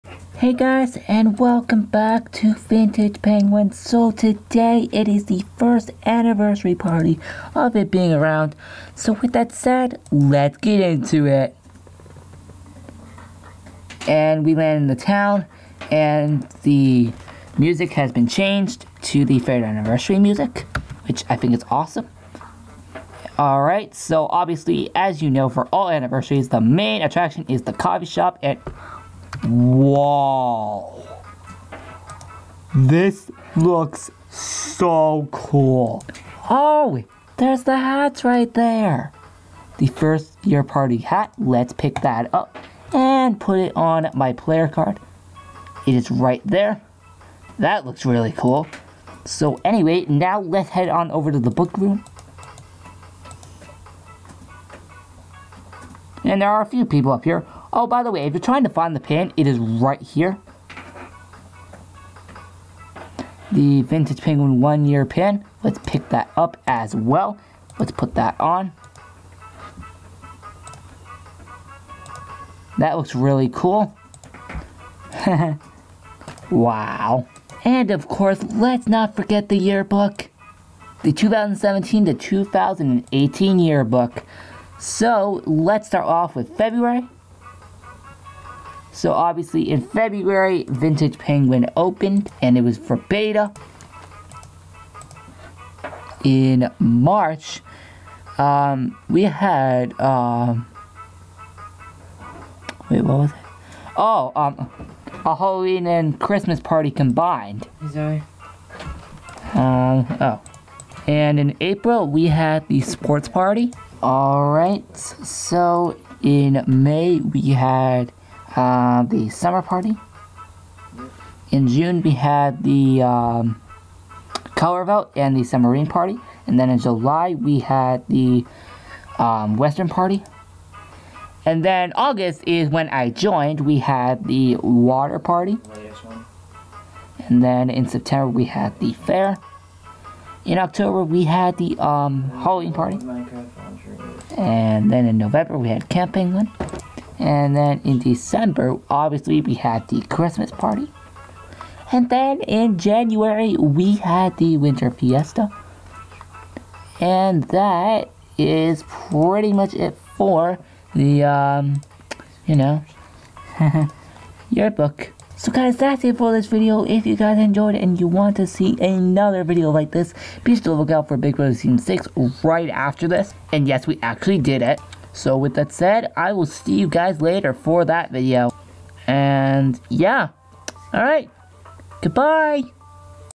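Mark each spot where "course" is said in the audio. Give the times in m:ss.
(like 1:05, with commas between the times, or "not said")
1:18.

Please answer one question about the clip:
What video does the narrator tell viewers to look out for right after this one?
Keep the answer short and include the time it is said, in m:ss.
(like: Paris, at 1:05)
Big Brother Season 6, at 2:51.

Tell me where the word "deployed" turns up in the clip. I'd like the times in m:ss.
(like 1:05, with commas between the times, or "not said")
not said.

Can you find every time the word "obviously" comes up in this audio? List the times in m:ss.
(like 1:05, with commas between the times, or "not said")
0:24, 1:29, 2:28.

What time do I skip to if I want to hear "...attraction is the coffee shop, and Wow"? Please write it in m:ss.
0:27.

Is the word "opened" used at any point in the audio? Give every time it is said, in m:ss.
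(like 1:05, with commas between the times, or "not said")
1:31.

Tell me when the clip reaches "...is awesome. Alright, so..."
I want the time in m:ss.
0:21.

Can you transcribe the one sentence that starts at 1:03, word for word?
The Vintage Penguin one year pin.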